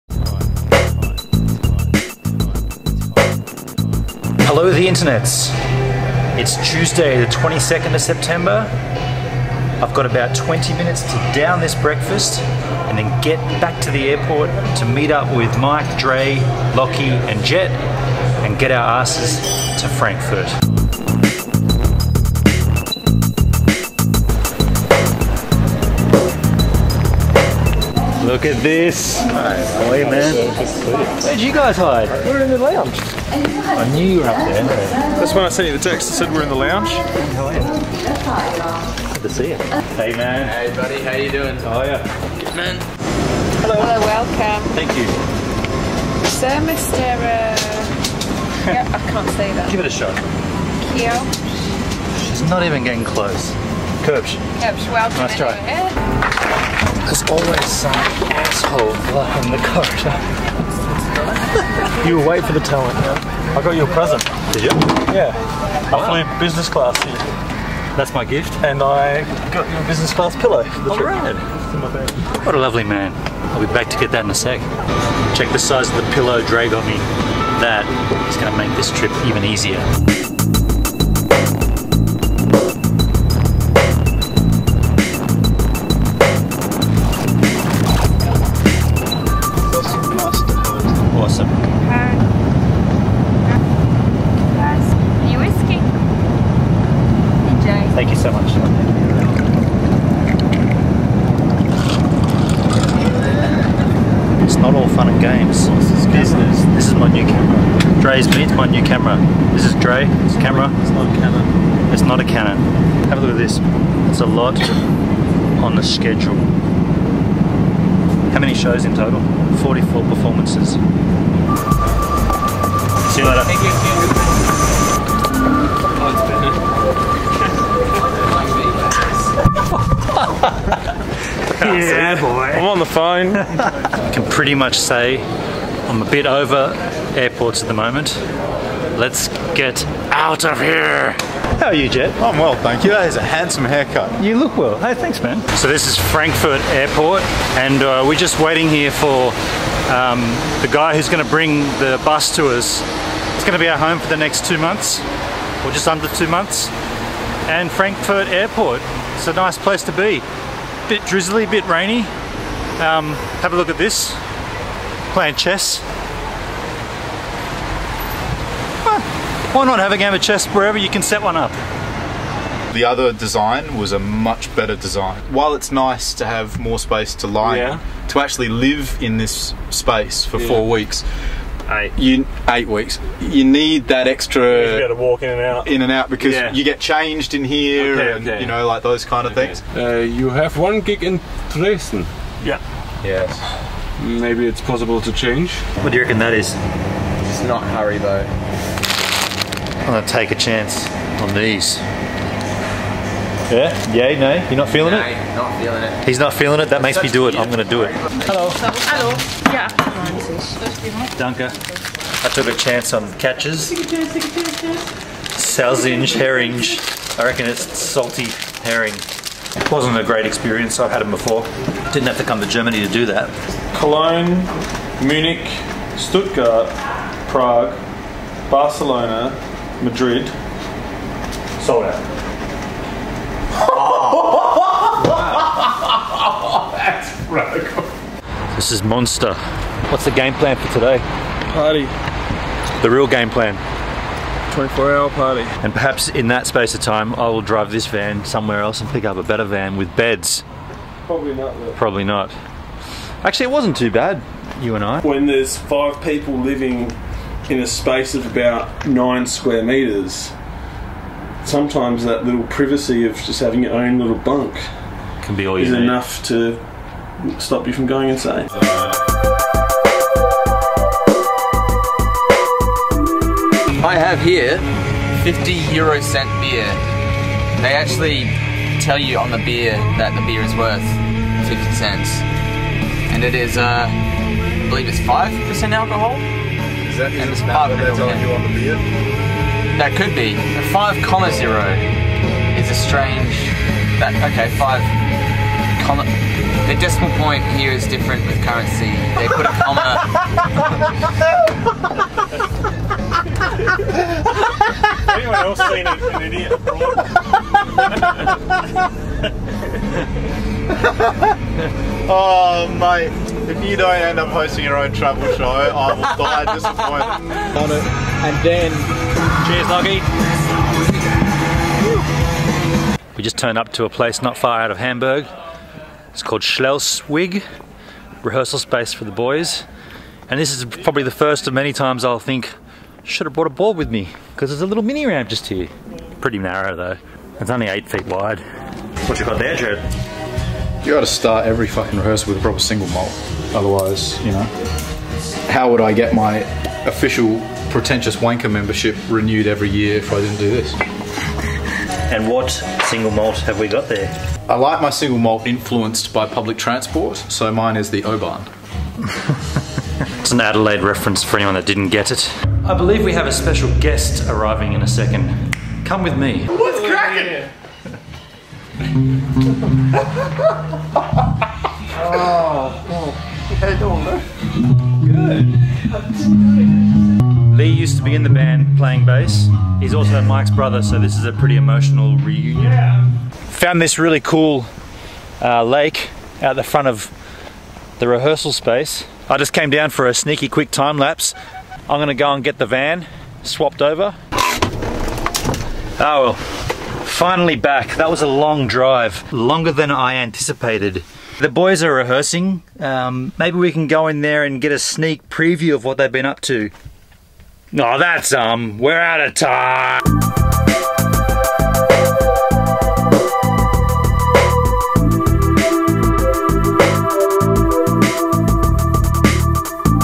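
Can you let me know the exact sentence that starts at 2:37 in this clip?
And Frankfurt Airport, it's a nice place to be bit drizzly, bit rainy.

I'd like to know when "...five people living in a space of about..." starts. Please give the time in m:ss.
4:15.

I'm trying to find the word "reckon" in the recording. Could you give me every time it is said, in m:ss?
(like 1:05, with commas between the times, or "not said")
3:16, 3:37.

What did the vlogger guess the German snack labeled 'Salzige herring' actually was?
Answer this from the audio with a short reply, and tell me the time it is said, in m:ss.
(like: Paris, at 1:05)
Salty herring, at 3:37.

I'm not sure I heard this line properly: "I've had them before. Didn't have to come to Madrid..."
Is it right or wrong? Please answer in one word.
wrong.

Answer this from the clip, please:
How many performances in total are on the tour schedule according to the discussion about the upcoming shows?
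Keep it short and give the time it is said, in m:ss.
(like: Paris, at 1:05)
44, at 1:59.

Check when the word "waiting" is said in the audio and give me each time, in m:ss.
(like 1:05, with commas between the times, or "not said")
1:02, 2:28.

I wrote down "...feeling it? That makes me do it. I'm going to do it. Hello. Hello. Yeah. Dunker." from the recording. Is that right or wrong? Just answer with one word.
right.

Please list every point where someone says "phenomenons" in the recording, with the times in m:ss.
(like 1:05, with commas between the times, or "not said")
not said.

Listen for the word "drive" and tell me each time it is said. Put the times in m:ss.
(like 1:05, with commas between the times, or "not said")
4:07, 6:38.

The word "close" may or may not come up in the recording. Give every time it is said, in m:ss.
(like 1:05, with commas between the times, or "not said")
0:53.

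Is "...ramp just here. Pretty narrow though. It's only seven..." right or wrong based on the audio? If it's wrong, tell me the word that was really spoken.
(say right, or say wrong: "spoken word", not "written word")
wrong: "eight", not "seven".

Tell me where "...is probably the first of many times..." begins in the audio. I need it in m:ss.
5:30.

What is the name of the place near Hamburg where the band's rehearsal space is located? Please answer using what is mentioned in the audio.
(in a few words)
Schleswig.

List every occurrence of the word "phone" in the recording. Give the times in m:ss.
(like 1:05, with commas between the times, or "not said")
2:12.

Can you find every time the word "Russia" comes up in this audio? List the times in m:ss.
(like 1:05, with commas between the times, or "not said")
not said.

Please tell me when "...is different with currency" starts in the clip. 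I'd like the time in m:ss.
4:57.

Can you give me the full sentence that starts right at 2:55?
While it's nice to have more space to lie yeah.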